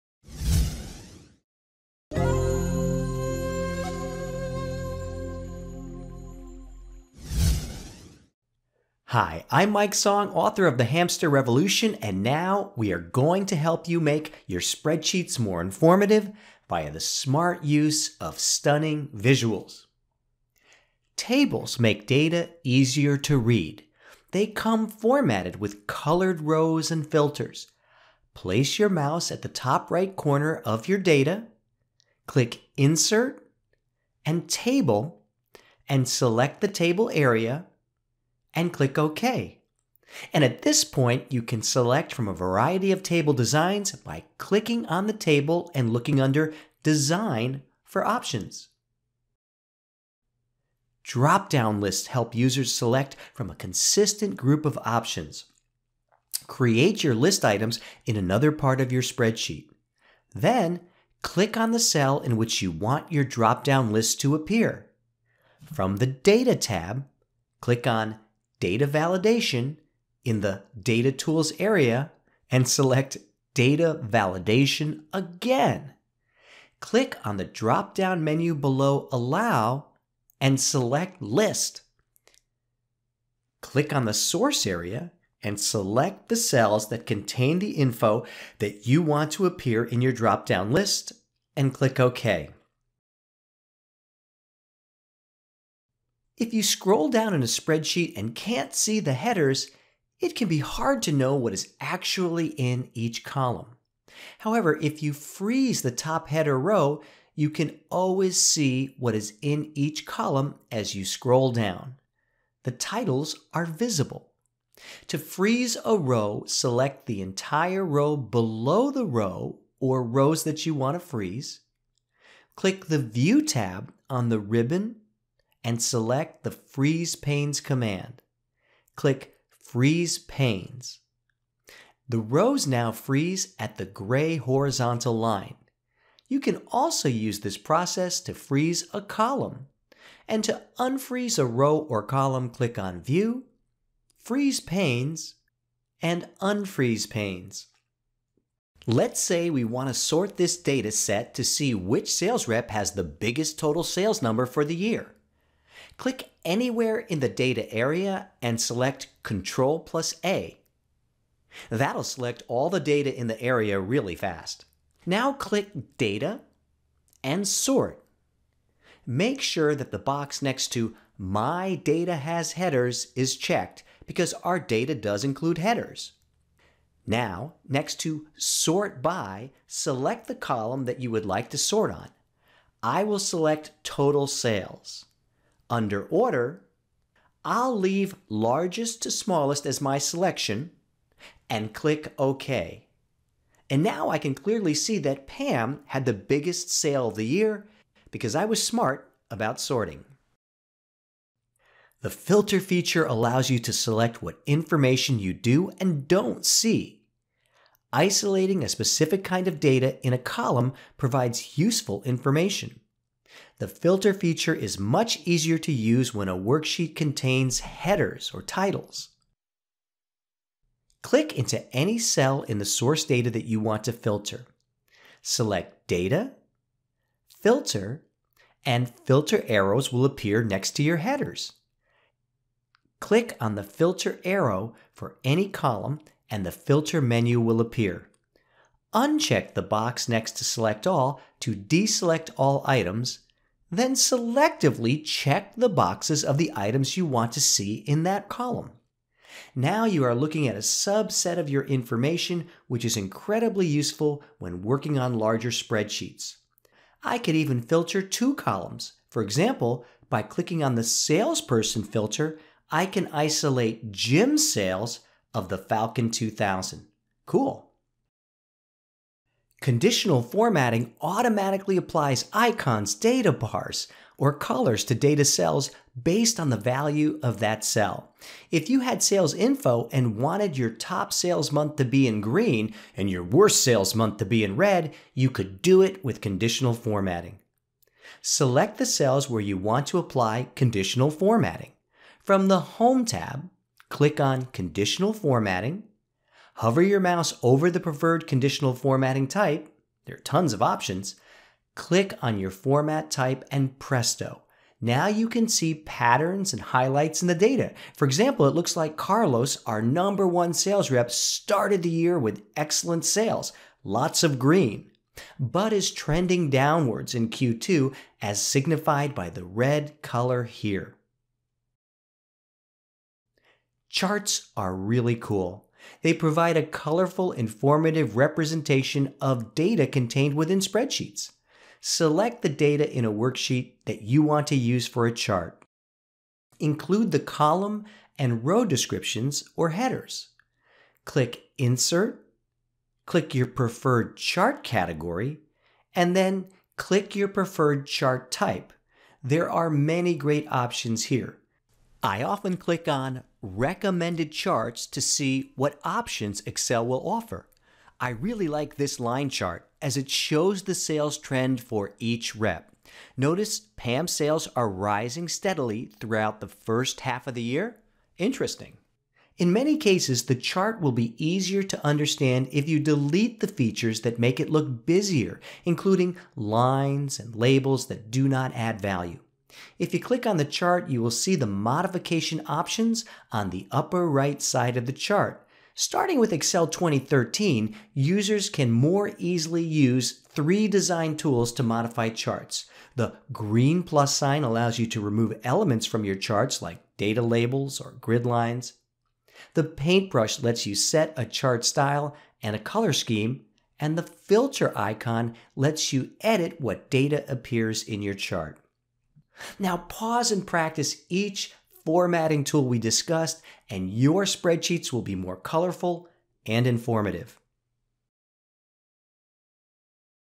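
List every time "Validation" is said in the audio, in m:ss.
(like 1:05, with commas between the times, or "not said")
1:08, 1:14.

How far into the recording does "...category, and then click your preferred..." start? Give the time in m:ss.
5:44.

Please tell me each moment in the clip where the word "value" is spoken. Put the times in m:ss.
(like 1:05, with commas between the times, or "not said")
4:36, 6:18.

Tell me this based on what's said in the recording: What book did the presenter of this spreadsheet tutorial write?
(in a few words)
The Hamster Revolution.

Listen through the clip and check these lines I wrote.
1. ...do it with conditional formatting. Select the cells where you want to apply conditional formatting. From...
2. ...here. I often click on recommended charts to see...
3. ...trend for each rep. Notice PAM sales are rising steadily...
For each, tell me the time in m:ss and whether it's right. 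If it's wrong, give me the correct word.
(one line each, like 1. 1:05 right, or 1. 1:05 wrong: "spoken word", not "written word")
1. 4:45 right
2. 5:51 right
3. 6:01 right.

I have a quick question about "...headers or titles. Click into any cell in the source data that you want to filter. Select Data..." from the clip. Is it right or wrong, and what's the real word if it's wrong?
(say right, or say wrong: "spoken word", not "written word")
right.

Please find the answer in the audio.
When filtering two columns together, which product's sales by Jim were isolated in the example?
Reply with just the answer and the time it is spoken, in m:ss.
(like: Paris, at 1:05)
Falcon 2000, at 4:25.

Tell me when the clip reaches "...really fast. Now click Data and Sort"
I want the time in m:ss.
2:43.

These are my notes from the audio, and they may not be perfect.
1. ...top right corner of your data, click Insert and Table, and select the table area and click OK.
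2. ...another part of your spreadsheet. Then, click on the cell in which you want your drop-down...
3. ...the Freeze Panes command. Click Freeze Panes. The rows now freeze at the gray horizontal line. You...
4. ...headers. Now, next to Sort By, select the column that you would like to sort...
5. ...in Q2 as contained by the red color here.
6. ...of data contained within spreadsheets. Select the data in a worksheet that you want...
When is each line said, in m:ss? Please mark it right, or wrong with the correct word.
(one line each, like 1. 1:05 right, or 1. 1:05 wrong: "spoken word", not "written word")
1. 0:29 right
2. 0:58 right
3. 2:06 right
4. 2:55 right
5. 5:17 wrong: "signified", not "contained"
6. 5:29 right.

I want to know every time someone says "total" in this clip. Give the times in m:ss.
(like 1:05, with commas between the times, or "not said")
2:33, 3:03.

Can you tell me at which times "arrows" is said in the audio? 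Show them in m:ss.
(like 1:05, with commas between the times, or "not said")
3:49, 3:54.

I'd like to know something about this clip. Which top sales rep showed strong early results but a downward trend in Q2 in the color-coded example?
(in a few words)
Carlos.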